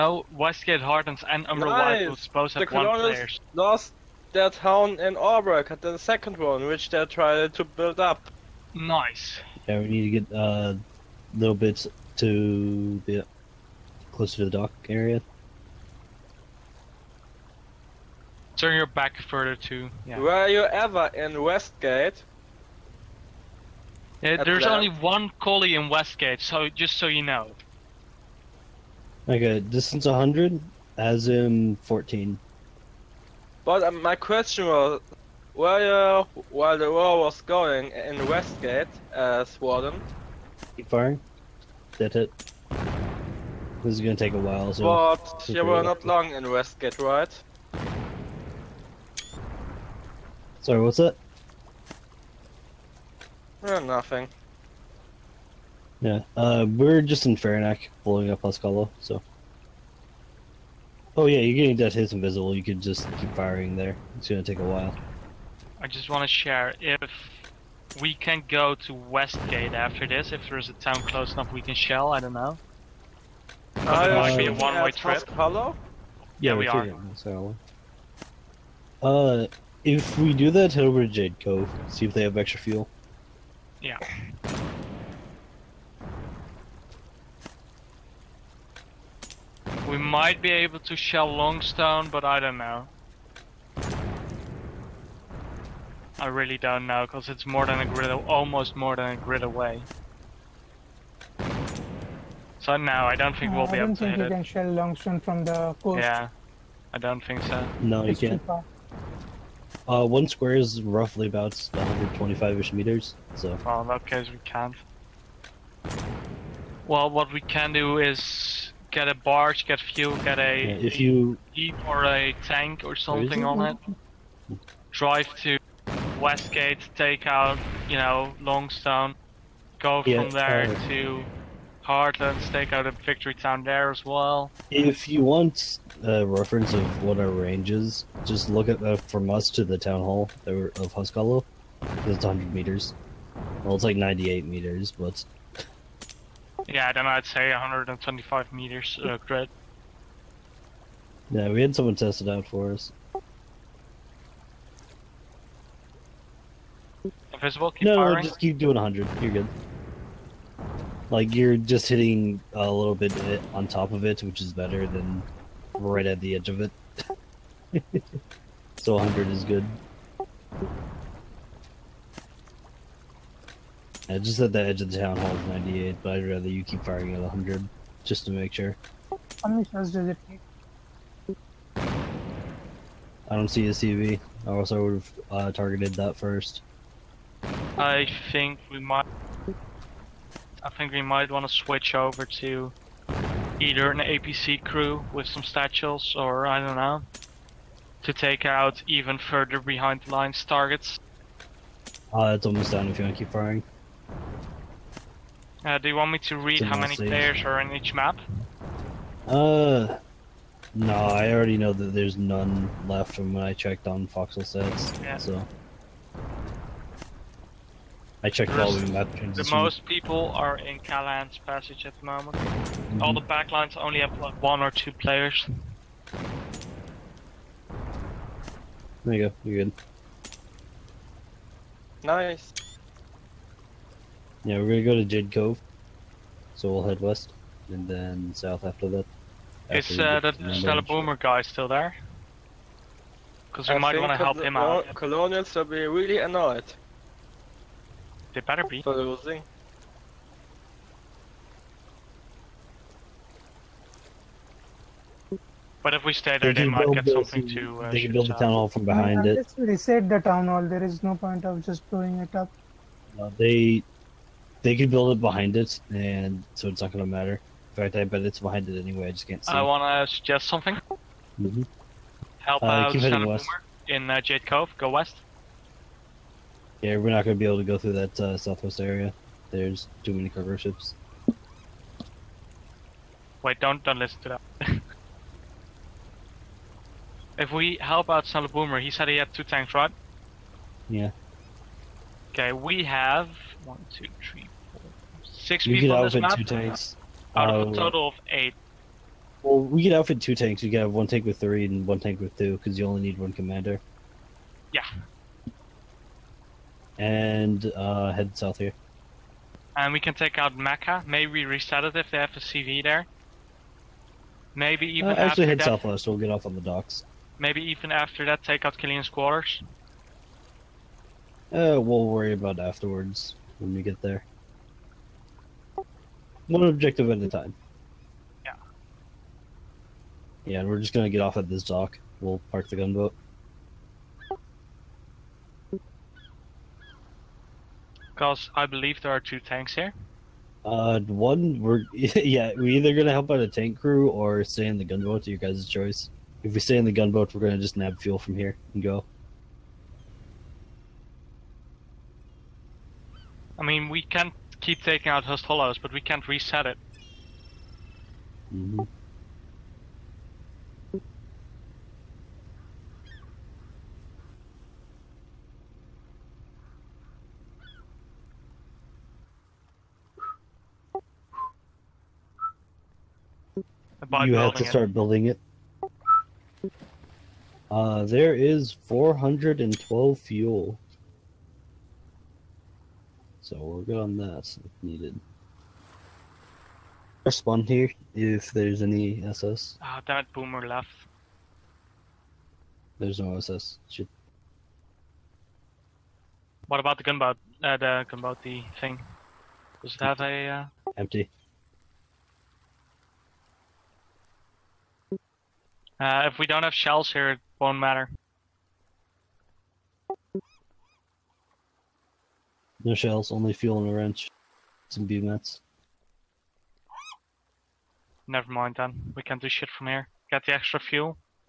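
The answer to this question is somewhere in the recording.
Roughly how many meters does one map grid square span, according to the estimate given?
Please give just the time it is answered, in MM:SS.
01:51.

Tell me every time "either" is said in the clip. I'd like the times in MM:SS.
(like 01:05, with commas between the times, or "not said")
03:13, 05:42.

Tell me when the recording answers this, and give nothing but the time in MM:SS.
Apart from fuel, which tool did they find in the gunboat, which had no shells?
06:53.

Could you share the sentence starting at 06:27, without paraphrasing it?
Respond here if there's any SS.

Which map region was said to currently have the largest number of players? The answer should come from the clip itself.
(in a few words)
Callahan's Passage.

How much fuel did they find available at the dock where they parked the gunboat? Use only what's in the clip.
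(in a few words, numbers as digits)
412.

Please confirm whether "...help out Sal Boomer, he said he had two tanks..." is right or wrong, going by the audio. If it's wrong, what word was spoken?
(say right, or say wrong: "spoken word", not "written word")
right.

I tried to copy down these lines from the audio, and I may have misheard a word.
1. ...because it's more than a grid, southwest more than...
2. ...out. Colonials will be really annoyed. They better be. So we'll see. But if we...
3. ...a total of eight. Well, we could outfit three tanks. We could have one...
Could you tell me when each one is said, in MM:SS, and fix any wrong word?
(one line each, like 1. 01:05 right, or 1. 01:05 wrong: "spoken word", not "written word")
1. 01:37 wrong: "almost", not "southwest"
2. 04:04 right
3. 04:57 wrong: "two", not "three".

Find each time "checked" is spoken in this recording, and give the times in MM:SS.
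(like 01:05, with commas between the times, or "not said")
03:33, 03:38.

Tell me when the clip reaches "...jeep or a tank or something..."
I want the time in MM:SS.
02:01.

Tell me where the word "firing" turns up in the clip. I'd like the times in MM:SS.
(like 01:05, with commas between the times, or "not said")
00:40, 01:03, 02:37, 02:56, 03:23.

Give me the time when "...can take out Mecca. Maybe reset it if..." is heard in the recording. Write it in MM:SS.
05:09.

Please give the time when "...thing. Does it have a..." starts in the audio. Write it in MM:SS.
06:38.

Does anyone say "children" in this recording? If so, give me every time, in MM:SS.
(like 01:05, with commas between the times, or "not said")
not said.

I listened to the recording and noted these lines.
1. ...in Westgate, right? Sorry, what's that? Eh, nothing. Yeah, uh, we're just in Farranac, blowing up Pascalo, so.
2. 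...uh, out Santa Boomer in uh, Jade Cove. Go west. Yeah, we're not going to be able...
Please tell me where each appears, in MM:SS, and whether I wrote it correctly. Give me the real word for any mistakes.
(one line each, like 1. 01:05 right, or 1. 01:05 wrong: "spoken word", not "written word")
1. 00:46 right
2. 04:32 right.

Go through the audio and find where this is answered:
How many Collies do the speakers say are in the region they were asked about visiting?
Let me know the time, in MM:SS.
00:24.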